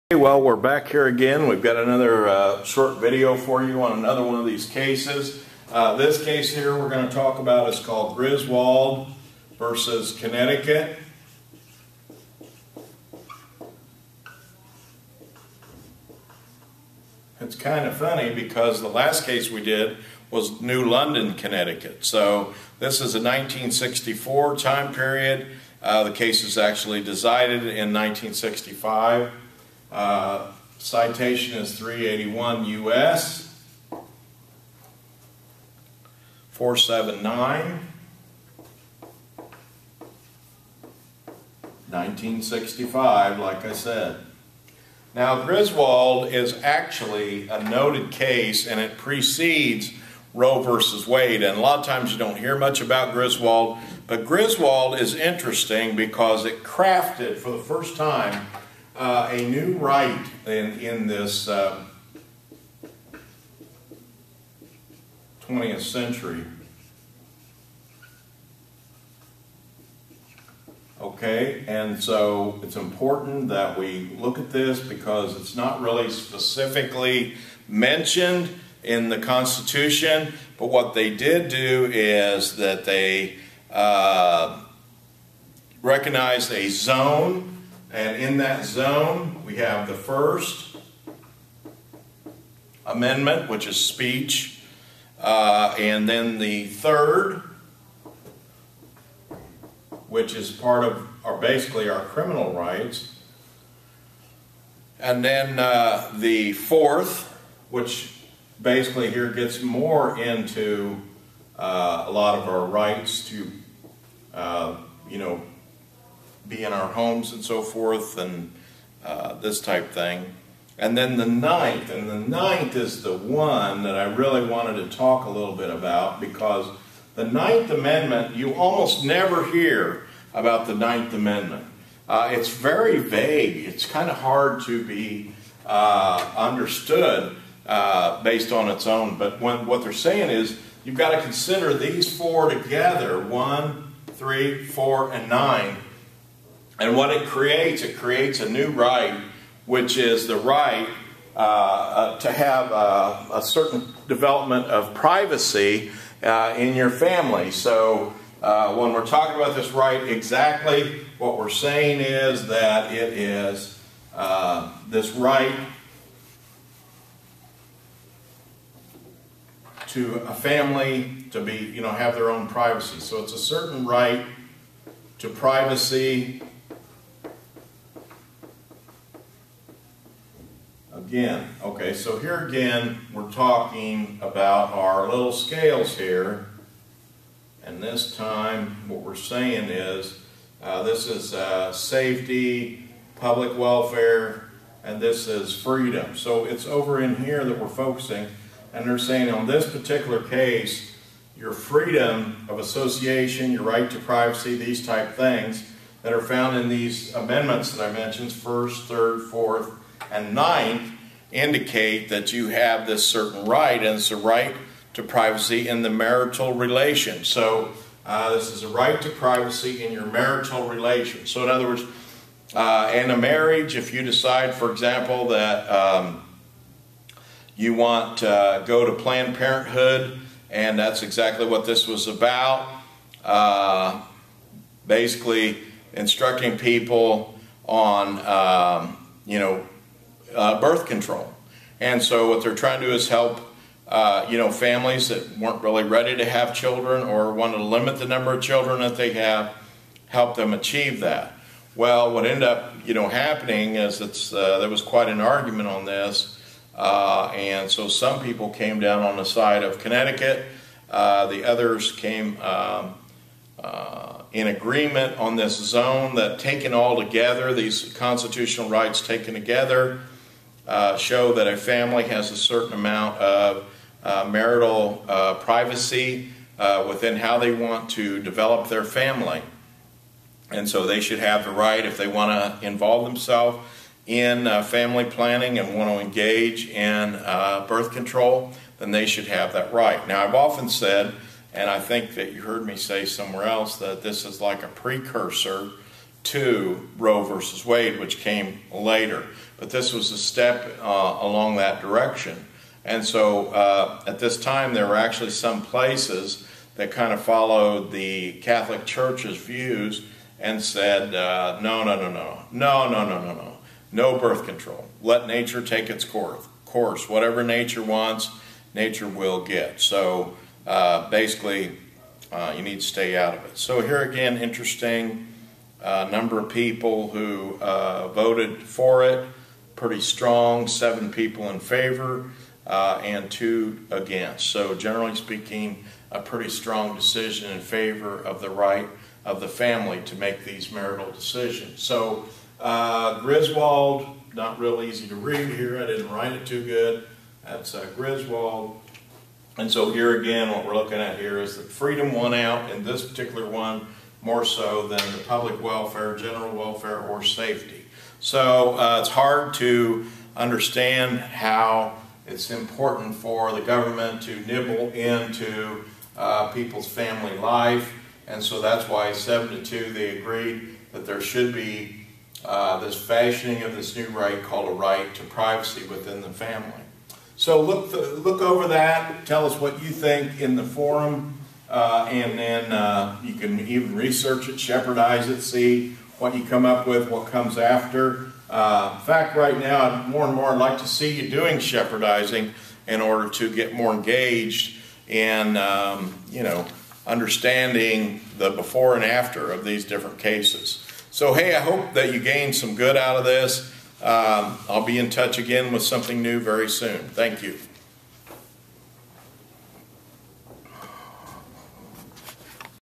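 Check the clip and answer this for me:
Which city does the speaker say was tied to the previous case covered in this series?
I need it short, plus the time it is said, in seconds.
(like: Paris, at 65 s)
New London, at 20 s.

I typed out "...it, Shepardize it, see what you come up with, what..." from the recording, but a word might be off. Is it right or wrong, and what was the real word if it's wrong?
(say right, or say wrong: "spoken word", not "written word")
right.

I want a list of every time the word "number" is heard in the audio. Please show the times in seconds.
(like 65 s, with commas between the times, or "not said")
248 s, 326 s.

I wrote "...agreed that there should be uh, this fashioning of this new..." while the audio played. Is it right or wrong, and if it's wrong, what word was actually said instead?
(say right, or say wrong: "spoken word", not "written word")
right.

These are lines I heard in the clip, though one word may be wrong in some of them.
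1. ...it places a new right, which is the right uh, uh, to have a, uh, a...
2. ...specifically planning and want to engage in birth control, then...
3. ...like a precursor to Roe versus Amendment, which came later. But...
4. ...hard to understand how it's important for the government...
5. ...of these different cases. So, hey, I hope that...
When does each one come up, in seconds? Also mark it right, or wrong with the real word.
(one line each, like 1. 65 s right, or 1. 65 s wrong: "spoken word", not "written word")
1. 147 s wrong: "creates", not "places"
2. 284 s wrong: "family", not "specifically"
3. 294 s wrong: "Wade", not "Amendment"
4. 359 s right
5. 399 s right.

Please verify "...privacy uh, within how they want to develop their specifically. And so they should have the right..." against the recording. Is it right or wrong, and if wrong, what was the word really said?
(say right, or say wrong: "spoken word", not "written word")
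wrong: "family", not "specifically".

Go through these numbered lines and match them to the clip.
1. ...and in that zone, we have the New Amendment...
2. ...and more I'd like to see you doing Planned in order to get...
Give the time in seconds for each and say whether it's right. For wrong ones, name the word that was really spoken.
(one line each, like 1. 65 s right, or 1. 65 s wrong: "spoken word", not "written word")
1. 87 s wrong: "First", not "New"
2. 390 s wrong: "Shepardizing", not "Planned".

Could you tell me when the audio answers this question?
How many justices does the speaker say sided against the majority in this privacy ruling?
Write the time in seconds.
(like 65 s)
333 s.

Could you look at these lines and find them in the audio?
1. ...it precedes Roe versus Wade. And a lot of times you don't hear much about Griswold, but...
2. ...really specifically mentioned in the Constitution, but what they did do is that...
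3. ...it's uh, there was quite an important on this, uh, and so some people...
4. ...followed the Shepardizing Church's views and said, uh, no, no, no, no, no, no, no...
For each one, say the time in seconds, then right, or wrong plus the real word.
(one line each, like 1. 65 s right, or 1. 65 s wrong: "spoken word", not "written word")
1. 48 s right
2. 75 s right
3. 253 s wrong: "argument", not "important"
4. 307 s wrong: "Catholic", not "Shepardizing".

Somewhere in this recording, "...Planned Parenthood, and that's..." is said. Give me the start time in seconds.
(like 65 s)
229 s.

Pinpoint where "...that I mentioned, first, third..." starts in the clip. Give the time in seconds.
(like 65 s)
207 s.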